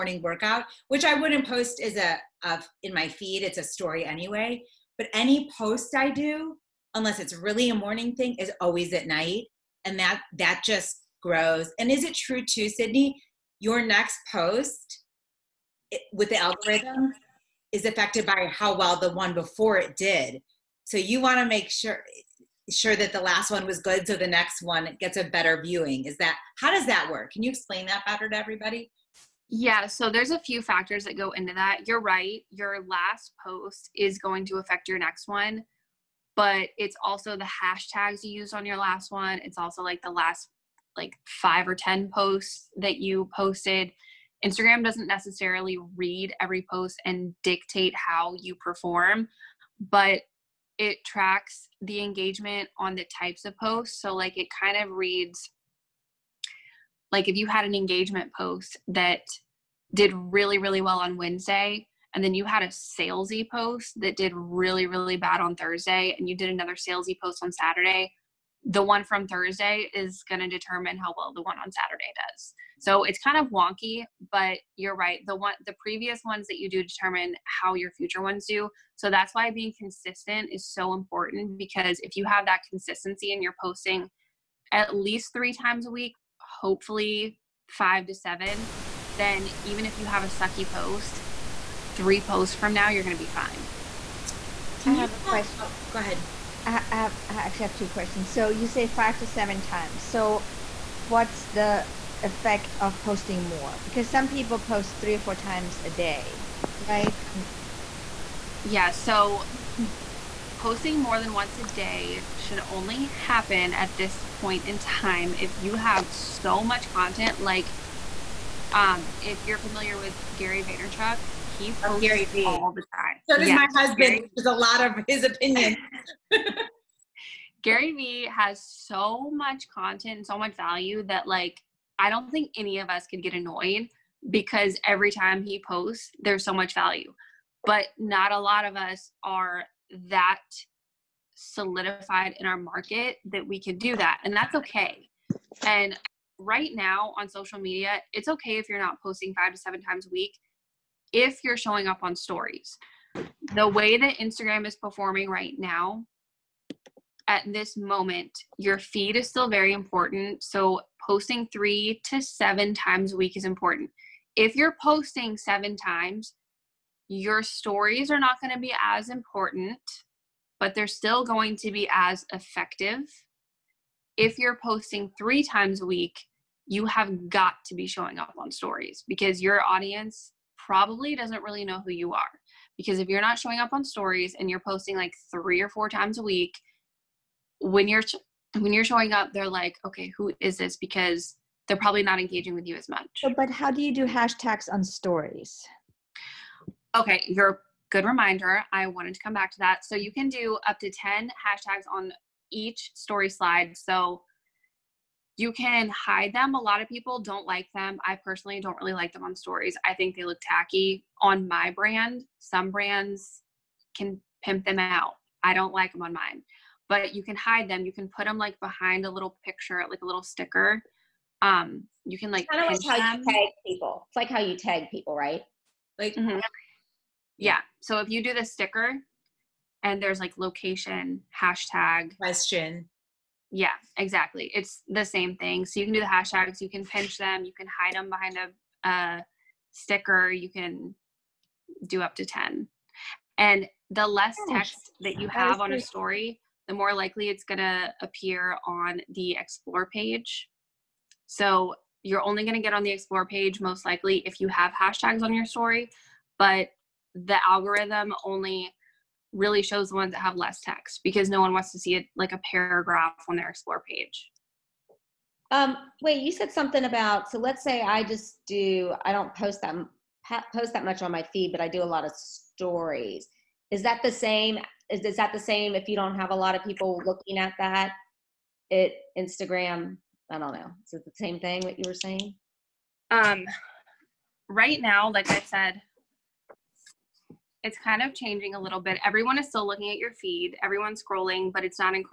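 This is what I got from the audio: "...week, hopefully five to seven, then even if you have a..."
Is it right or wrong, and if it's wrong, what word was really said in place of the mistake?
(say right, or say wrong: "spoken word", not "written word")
right.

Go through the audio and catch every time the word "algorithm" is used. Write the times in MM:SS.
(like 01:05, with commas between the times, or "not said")
00:16, 04:17.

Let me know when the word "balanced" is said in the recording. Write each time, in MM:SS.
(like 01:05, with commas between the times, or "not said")
not said.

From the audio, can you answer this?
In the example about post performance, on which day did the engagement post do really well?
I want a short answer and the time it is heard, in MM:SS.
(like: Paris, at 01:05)
Wednesday, at 01:01.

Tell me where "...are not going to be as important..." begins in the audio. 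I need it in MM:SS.
02:48.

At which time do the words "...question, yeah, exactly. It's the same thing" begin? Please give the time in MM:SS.
03:52.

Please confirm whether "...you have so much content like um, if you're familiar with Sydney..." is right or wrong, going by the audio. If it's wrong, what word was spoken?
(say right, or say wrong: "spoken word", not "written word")
wrong: "Gary", not "Sydney".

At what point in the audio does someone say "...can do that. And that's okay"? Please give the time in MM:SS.
02:23.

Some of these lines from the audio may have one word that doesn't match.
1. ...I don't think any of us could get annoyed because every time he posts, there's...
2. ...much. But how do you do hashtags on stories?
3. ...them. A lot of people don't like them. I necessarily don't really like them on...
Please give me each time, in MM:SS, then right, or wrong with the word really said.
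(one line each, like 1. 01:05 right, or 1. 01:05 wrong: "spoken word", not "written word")
1. 02:11 right
2. 03:12 right
3. 03:26 wrong: "personally", not "necessarily".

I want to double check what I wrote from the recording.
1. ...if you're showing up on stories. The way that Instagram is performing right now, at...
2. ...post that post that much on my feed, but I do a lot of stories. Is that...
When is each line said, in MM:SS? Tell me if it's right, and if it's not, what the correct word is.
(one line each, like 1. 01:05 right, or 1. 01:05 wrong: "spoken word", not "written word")
1. 02:31 right
2. 04:29 right.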